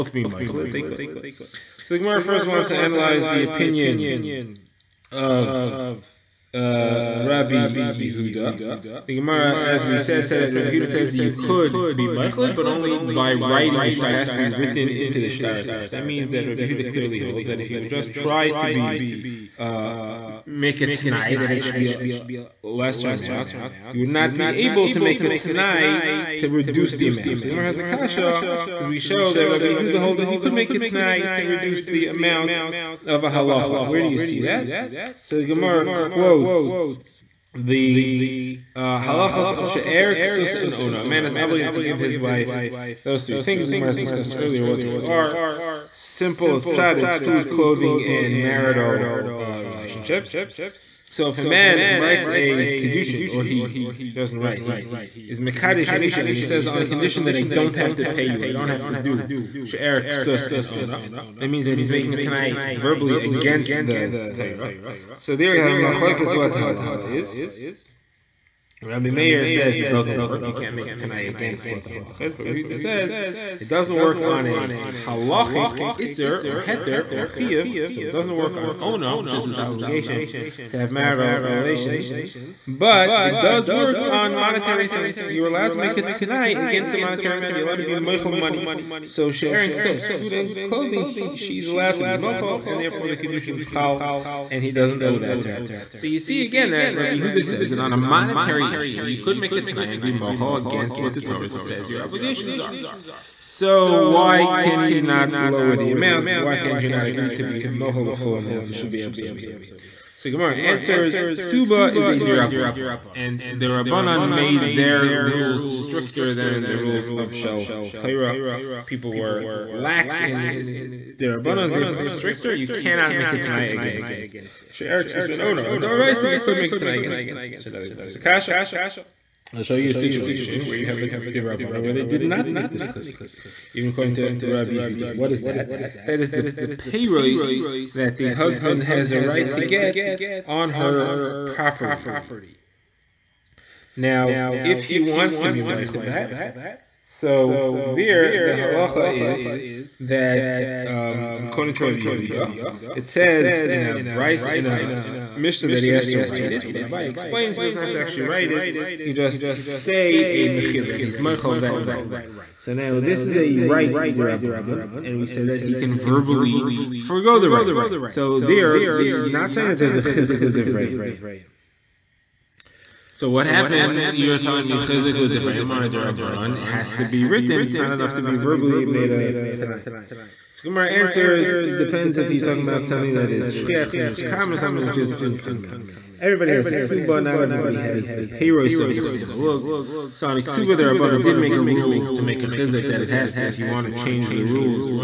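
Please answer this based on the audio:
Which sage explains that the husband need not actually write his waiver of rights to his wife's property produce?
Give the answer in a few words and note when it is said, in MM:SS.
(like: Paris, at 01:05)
Abai, at 02:36.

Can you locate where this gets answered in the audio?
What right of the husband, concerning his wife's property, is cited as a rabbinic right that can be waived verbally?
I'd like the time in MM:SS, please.
02:16.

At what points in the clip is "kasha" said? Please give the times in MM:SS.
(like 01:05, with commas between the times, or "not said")
00:27, 02:08.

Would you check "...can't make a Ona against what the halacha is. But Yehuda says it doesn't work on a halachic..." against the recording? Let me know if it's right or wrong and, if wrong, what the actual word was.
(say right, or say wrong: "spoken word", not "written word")
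wrong: "Tanai", not "Ona".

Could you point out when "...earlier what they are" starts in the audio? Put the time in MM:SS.
00:44.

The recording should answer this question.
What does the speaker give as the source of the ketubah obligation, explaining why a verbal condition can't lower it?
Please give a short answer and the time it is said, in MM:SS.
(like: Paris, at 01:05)
Dirabanan, at 01:51.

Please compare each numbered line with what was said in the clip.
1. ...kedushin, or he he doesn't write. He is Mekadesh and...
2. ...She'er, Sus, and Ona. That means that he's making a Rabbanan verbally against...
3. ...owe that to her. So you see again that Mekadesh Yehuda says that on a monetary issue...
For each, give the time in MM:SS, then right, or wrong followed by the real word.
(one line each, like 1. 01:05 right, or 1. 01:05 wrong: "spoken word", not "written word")
1. 00:52 right
2. 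00:59 wrong: "Tanai", not "Rabbanan"
3. 01:35 wrong: "Rabbi", not "Mekadesh".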